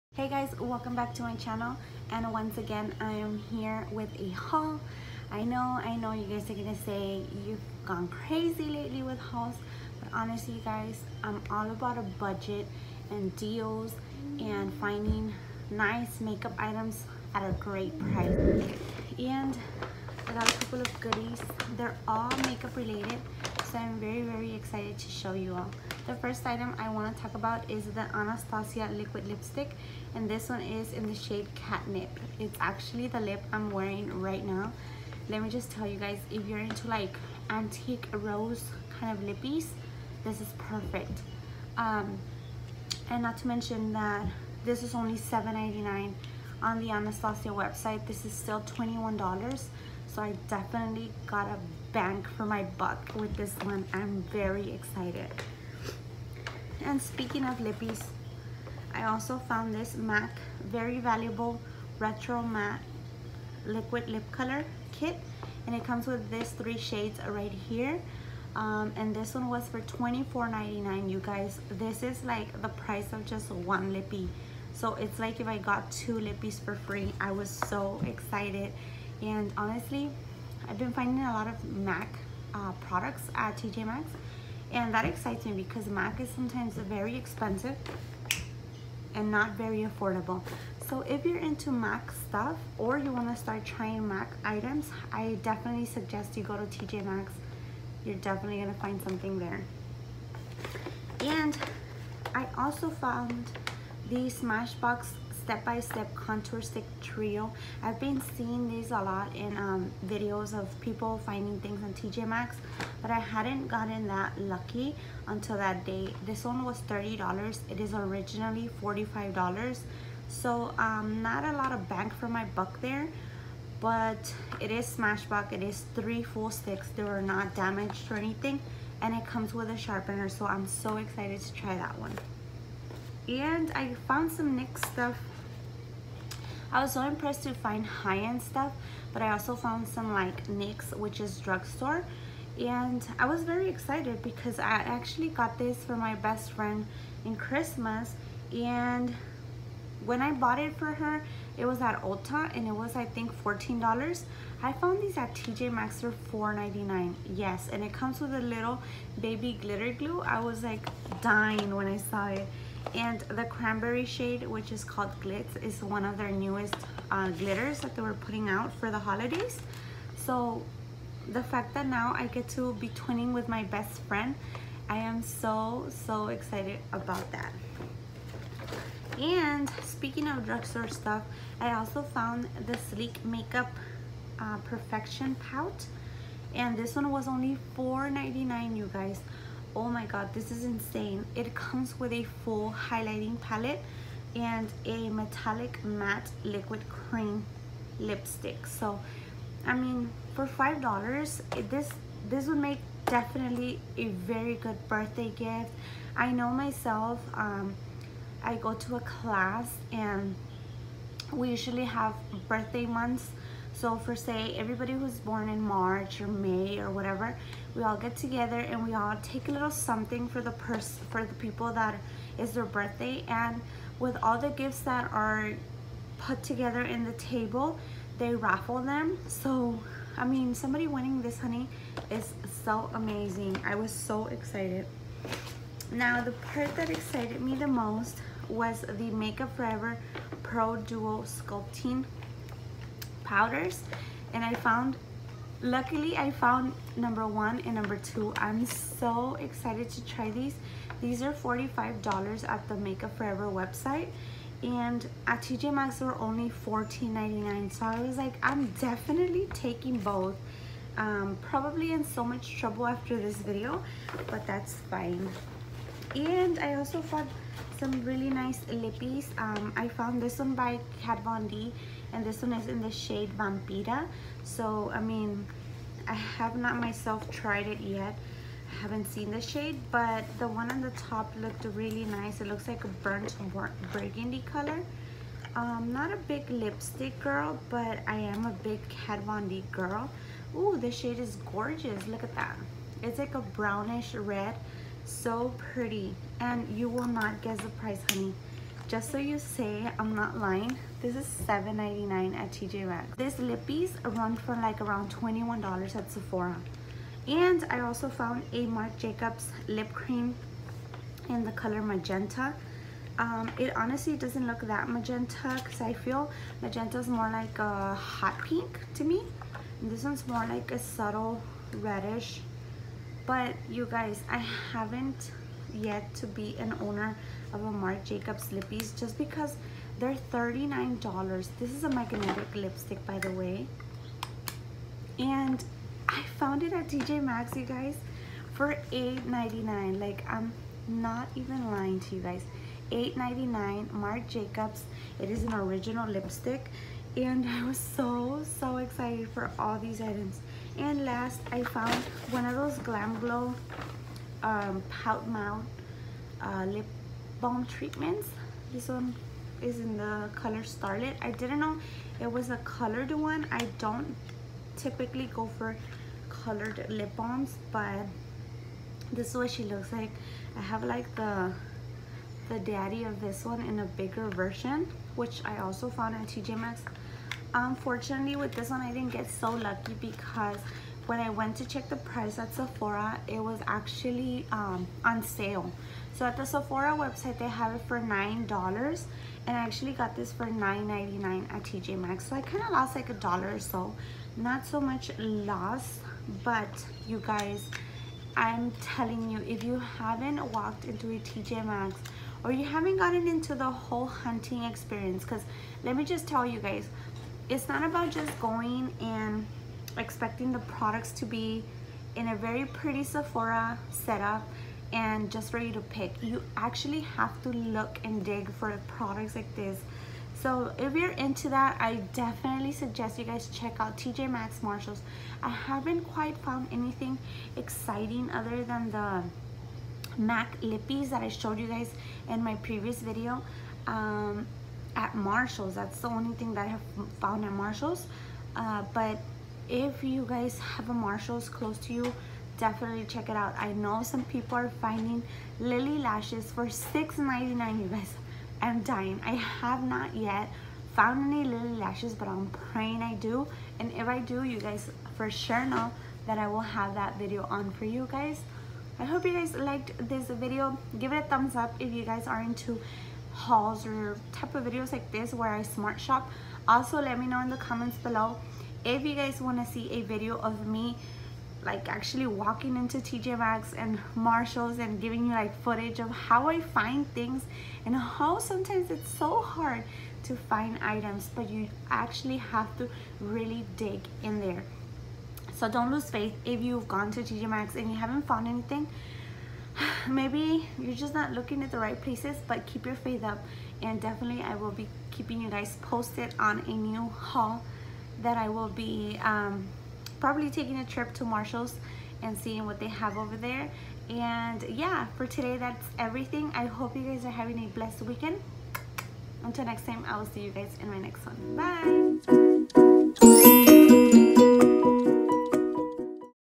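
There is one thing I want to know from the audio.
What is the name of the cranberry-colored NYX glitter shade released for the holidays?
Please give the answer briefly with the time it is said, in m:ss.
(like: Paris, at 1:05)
Glitz, at 2:45.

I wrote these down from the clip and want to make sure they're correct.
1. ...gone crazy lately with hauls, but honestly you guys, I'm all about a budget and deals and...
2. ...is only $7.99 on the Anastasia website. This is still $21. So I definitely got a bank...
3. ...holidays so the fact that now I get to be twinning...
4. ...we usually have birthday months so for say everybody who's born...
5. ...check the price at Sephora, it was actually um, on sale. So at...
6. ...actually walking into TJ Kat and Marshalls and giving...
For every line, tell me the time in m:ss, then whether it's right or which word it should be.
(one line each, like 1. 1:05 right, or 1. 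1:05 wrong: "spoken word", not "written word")
1. 0:07 right
2. 0:44 right
3. 2:48 right
4. 3:31 right
5. 6:21 right
6. 7:51 wrong: "Maxx", not "Kat".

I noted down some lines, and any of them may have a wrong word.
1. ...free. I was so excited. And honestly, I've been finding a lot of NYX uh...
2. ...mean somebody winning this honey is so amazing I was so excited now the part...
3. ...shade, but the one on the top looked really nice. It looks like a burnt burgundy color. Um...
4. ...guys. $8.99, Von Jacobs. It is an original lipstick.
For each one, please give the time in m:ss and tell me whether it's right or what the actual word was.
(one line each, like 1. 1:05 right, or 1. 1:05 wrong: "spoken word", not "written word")
1. 1:16 wrong: "MAC", not "NYX"
2. 3:50 right
3. 4:39 right
4. 5:42 wrong: "Marc", not "Von".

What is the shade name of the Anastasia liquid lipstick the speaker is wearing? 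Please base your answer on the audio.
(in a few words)
Catnip.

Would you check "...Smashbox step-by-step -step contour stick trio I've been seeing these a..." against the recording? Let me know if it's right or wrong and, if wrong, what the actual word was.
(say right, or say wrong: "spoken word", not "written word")
right.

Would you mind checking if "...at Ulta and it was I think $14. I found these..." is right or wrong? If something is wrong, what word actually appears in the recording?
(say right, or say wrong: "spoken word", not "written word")
right.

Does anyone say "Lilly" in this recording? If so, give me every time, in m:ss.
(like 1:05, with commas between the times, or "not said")
7:25, 7:31.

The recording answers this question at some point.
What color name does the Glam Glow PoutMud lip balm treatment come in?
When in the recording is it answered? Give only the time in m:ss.
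6:00.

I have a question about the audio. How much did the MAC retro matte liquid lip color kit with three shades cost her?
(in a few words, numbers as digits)
$24.99.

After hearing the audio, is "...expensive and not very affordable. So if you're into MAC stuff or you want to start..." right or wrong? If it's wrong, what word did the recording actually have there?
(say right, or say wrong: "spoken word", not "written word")
right.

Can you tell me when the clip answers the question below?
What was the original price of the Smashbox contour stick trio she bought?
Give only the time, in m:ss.
1:58.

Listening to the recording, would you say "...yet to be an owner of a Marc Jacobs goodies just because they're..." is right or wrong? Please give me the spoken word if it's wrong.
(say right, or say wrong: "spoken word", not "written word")
wrong: "lippies", not "goodies".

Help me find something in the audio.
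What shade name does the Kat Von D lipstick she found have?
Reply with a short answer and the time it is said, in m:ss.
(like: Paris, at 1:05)
Vampira, at 4:33.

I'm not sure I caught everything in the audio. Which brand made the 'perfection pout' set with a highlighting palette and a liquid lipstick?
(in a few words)
Sleek.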